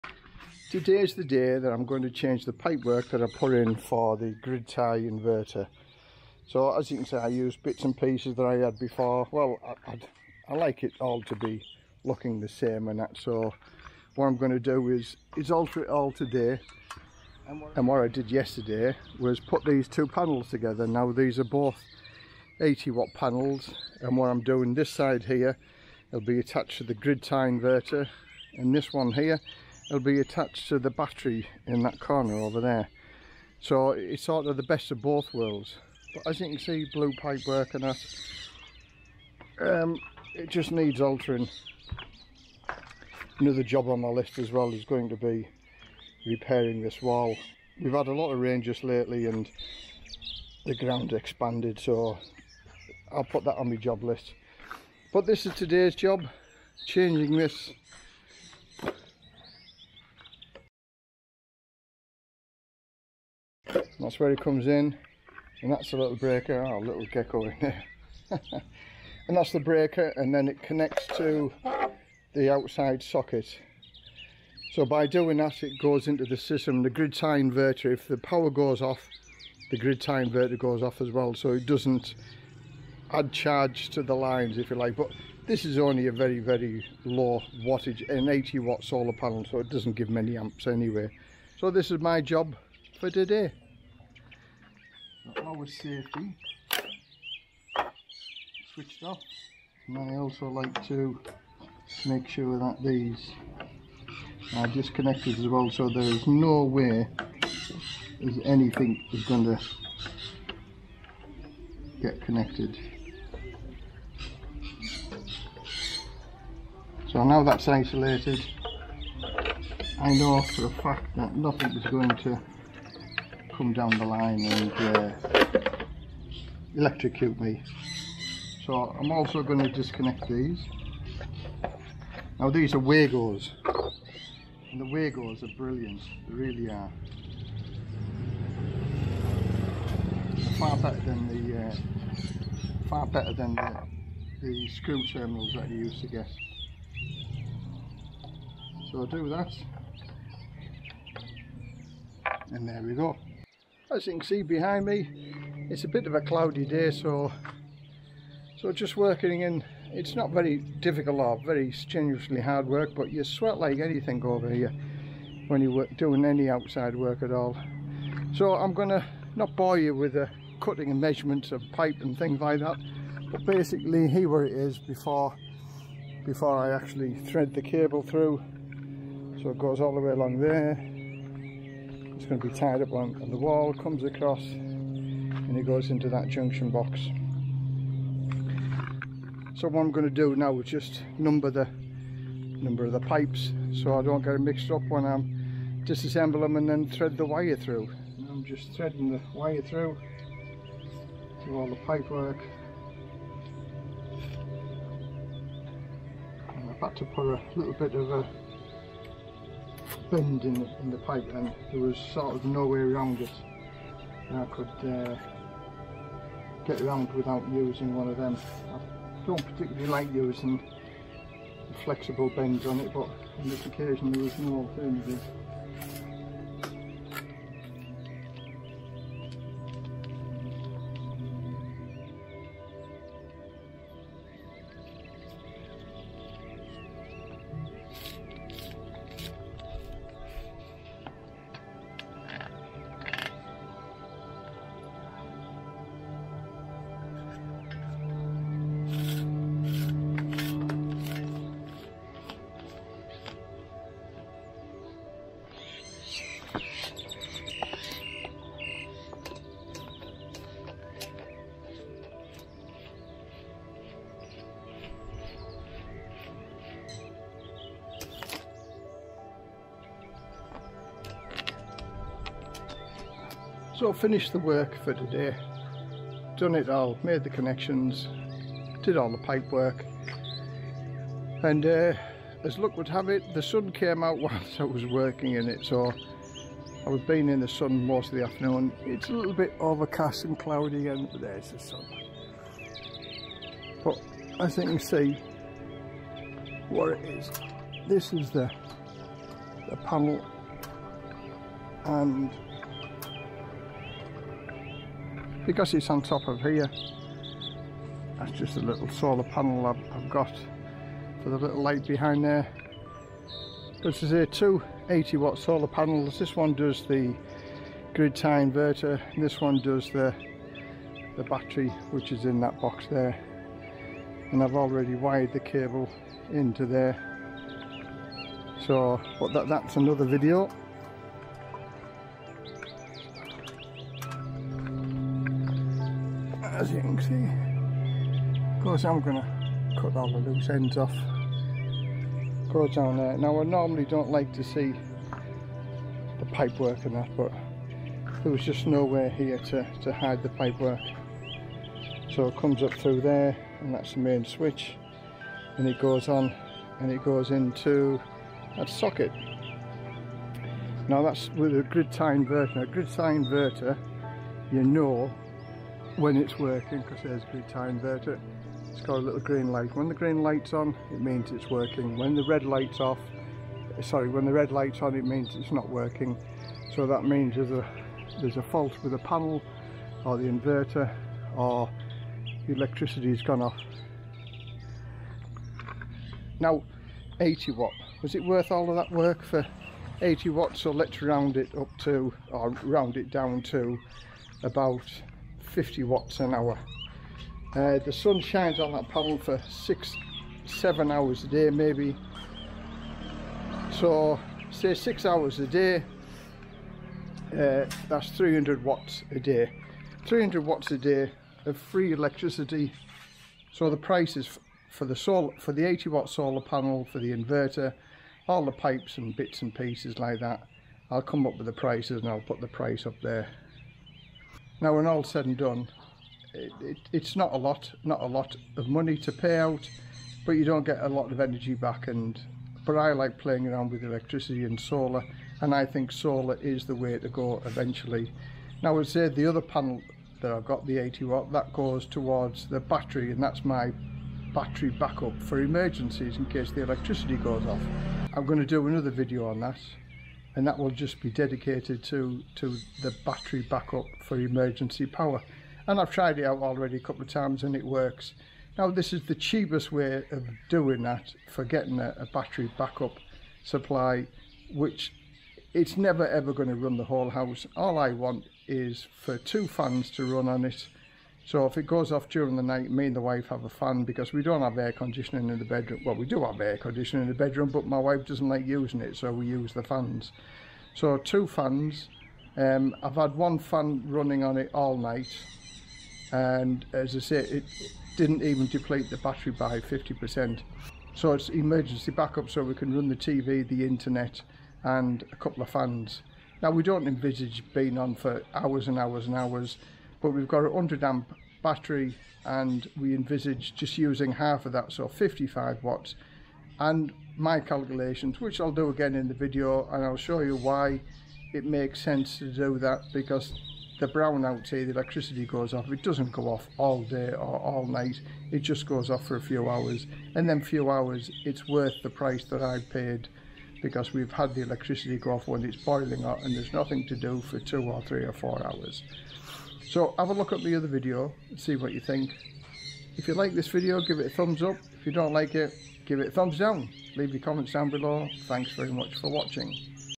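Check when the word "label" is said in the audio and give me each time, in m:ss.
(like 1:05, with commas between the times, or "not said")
not said.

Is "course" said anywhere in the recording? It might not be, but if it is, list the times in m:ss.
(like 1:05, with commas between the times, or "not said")
5:38.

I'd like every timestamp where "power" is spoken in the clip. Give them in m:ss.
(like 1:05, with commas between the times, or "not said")
1:18, 7:34.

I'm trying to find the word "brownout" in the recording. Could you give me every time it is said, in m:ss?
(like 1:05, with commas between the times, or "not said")
8:33.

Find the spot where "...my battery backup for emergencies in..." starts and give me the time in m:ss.
7:23.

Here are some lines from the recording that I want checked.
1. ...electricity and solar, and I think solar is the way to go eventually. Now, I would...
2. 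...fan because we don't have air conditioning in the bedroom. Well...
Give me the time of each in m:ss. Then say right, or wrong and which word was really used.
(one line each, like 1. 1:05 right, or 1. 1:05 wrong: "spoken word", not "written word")
1. 7:13 right
2. 7:53 right.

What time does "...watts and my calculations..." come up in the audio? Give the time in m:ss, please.
8:25.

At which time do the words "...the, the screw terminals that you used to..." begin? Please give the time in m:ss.
2:23.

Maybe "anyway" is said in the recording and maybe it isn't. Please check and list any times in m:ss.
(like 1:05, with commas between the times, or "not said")
1:30.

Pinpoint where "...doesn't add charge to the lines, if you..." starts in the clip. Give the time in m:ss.
1:21.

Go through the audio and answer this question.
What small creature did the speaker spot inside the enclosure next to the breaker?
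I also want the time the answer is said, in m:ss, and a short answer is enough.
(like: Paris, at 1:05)
gecko, at 1:07.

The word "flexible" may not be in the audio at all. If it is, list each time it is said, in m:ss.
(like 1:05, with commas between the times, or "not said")
3:41.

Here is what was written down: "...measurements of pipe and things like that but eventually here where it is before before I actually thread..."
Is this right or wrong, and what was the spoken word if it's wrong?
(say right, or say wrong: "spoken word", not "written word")
wrong: "basically", not "eventually".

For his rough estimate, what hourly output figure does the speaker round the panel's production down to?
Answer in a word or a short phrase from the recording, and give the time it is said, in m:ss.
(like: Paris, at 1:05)
50 watts, at 6:35.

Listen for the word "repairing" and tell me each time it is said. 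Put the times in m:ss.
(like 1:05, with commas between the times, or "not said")
0:46.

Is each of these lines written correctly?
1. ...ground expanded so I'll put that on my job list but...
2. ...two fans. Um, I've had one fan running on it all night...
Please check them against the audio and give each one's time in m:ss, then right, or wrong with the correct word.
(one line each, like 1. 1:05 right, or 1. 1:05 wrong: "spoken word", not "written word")
1. 0:50 right
2. 8:00 right.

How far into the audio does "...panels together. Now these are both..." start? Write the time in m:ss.
0:20.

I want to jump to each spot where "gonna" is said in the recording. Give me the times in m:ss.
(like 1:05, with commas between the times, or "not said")
2:48, 5:38.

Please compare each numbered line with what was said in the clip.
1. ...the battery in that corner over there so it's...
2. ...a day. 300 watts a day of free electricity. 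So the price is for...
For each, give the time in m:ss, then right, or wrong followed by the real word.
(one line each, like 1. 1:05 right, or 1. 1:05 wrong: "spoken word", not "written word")
1. 0:30 right
2. 6:49 right.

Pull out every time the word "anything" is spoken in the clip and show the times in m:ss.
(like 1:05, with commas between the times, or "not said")
1:48, 2:43.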